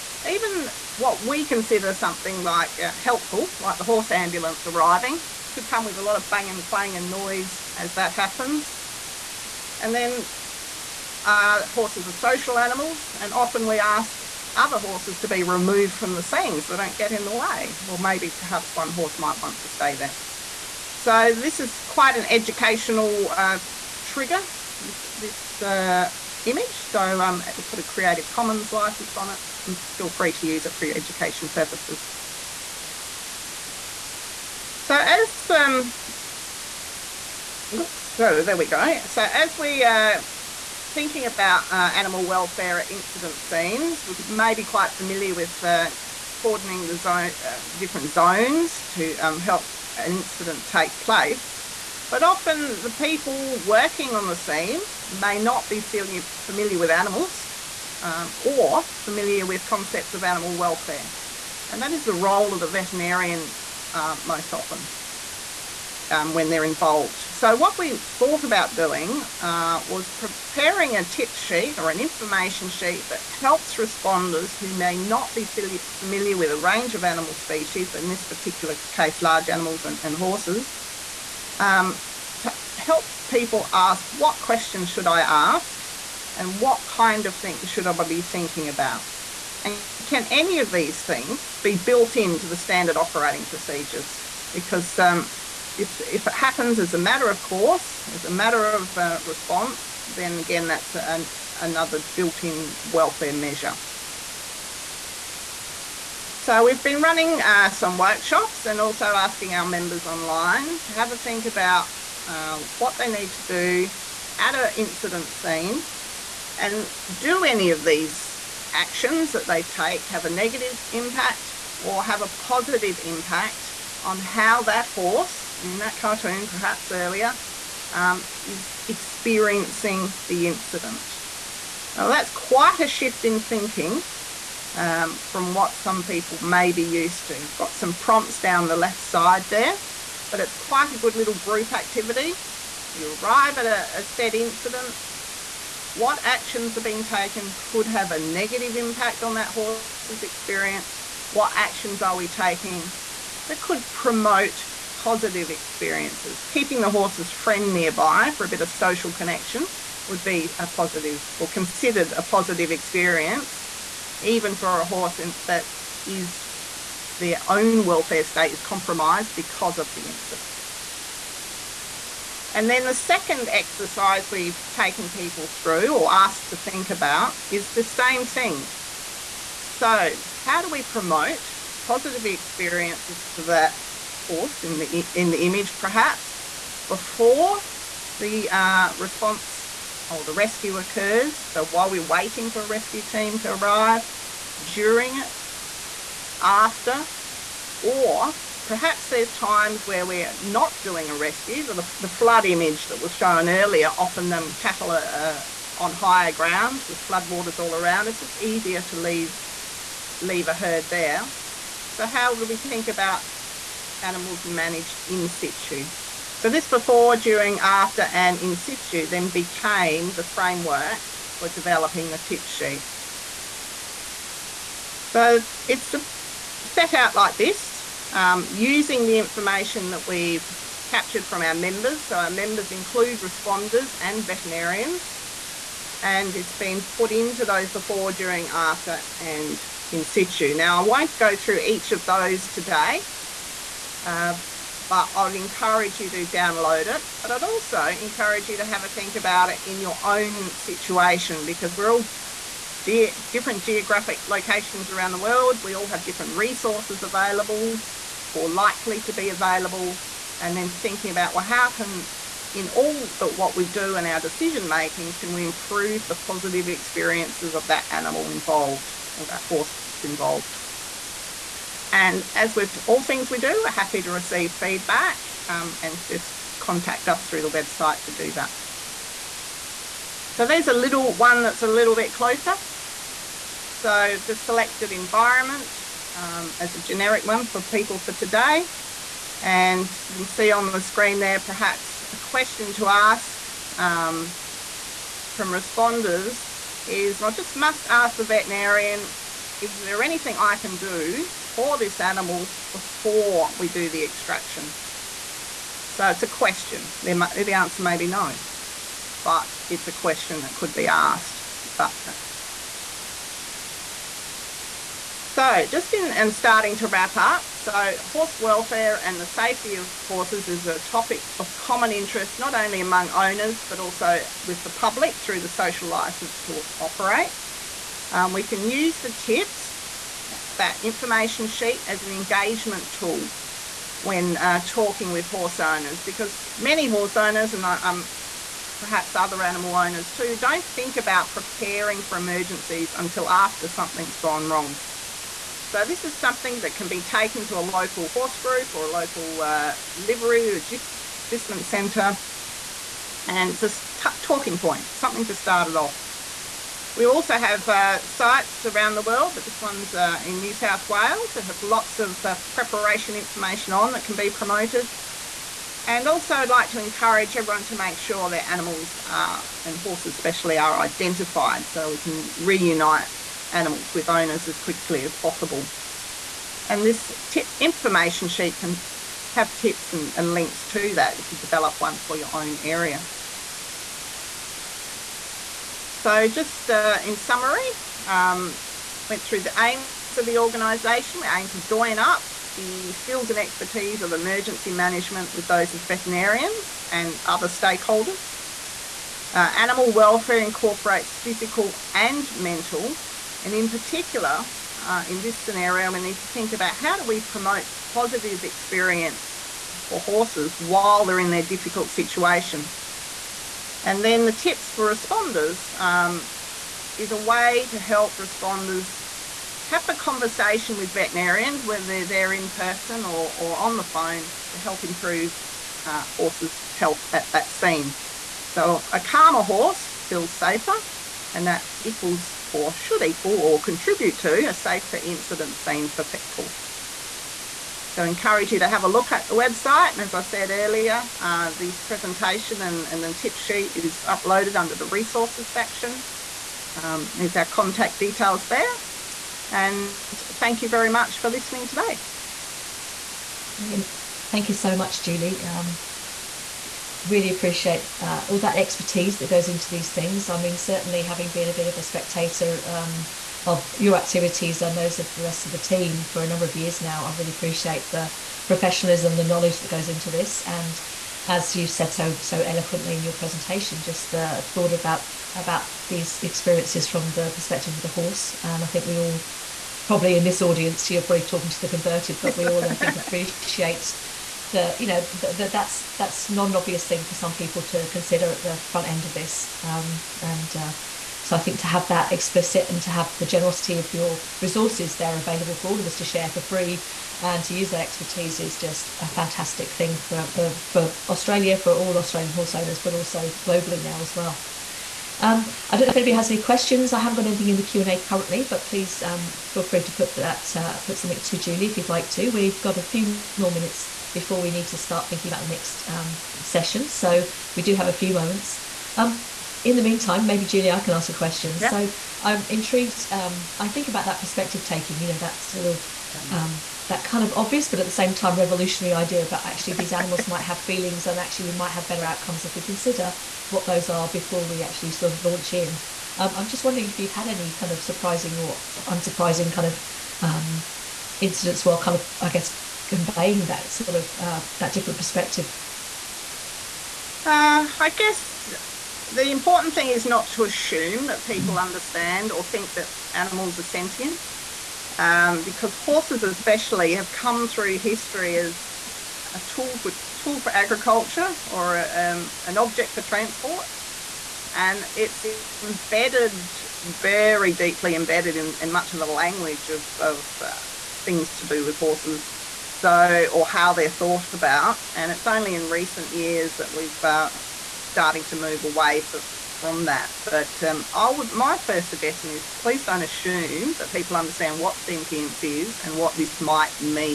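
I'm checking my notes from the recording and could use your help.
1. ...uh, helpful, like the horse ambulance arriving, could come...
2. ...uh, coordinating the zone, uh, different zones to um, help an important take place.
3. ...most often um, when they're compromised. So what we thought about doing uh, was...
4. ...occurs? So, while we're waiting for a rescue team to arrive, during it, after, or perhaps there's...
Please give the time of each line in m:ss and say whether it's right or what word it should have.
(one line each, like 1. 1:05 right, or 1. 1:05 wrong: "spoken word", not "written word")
1. 0:02 right
2. 0:45 wrong: "incident", not "important"
3. 1:04 wrong: "involved", not "compromised"
4. 3:10 right.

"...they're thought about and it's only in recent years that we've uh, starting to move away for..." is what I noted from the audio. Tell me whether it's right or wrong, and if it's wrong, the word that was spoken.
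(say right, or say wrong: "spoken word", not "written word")
right.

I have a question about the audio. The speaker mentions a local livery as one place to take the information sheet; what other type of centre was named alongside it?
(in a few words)
agistment centre.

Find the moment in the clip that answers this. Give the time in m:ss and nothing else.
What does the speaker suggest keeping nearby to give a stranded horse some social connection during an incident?
2:36.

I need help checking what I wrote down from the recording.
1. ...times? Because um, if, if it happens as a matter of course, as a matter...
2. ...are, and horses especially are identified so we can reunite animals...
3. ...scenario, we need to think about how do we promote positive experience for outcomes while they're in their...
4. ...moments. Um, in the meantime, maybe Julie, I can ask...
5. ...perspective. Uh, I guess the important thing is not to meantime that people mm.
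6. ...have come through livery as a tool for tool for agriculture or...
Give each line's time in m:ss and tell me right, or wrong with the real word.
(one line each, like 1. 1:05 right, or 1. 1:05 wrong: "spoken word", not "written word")
1. 1:33 wrong: "procedures", not "times"
2. 6:09 right
3. 6:45 wrong: "horses", not "outcomes"
4. 8:38 right
5. 9:04 wrong: "assume", not "meantime"
6. 9:16 wrong: "history", not "livery".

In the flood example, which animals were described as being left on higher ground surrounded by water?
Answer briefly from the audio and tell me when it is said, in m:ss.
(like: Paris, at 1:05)
cattle, at 3:24.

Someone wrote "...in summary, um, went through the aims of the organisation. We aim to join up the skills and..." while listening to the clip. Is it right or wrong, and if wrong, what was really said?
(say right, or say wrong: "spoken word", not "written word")
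right.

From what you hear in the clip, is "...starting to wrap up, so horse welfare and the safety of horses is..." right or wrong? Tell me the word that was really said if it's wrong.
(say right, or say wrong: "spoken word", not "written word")
right.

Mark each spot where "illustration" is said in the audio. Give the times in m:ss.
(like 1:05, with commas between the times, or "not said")
not said.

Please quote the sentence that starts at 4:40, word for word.
So there's a little one that's a little bit closer.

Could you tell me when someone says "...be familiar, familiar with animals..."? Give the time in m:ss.
0:55.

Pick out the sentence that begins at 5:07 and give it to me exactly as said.
The answer may be no, but it's a question that could be asked.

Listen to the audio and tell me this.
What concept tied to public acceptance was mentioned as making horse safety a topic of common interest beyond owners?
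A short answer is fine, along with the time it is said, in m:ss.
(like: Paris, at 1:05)
social license to operate, at 5:25.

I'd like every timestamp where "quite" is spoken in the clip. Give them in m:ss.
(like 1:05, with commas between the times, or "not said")
0:21, 0:44, 2:12, 2:20.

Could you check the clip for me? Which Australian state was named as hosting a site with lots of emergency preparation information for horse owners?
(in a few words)
New South Wales.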